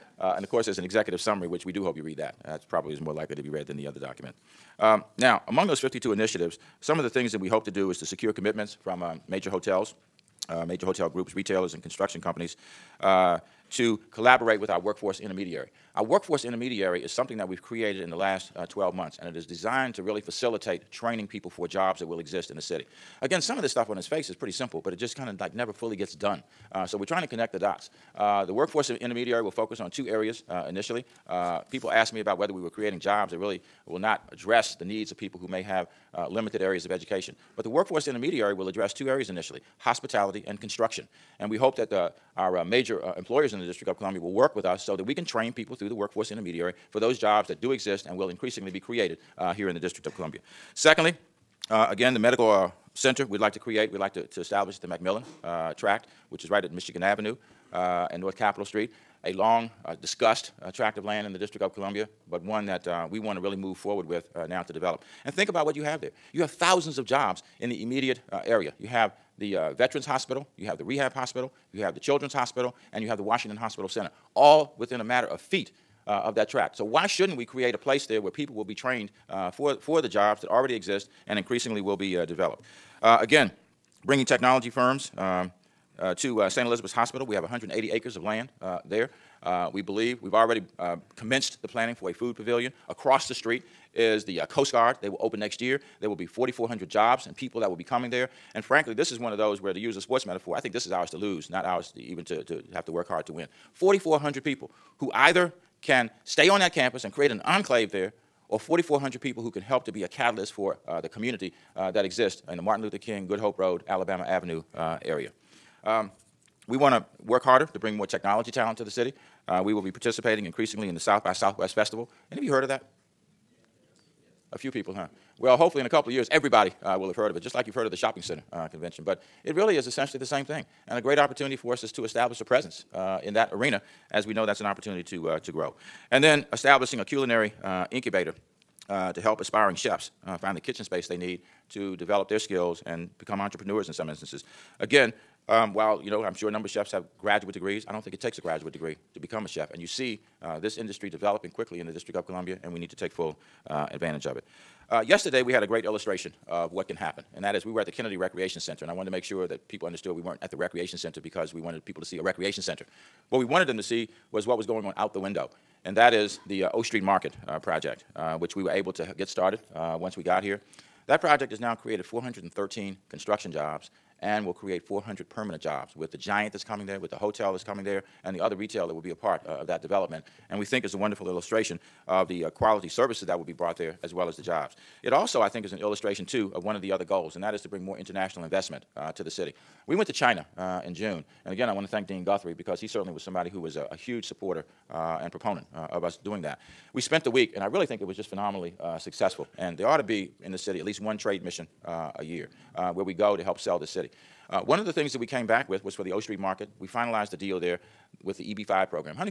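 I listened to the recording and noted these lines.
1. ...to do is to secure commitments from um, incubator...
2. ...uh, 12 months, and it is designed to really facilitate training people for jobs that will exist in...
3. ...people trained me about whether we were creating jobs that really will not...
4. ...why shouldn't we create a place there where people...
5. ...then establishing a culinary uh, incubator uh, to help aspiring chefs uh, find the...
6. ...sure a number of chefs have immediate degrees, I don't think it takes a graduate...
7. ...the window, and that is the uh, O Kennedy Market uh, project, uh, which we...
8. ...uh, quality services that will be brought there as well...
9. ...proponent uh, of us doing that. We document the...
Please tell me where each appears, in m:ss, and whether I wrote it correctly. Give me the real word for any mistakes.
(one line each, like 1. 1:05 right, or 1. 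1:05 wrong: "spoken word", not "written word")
1. 0:07 wrong: "major", not "incubator"
2. 0:18 right
3. 0:31 wrong: "asked", not "trained"
4. 1:16 right
5. 2:16 right
6. 2:26 wrong: "graduate", not "immediate"
7. 2:45 wrong: "Street", not "Kennedy"
8. 3:02 right
9. 3:15 wrong: "spent", not "document".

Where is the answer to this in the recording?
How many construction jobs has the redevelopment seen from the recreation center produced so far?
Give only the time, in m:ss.
2:52.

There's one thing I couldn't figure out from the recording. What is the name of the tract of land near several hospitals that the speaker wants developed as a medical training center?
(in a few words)
McMillan tract.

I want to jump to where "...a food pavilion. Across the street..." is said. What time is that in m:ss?
1:32.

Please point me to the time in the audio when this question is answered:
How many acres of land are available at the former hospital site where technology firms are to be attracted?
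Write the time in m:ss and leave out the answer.
1:27.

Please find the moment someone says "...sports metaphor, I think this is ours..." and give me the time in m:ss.
1:40.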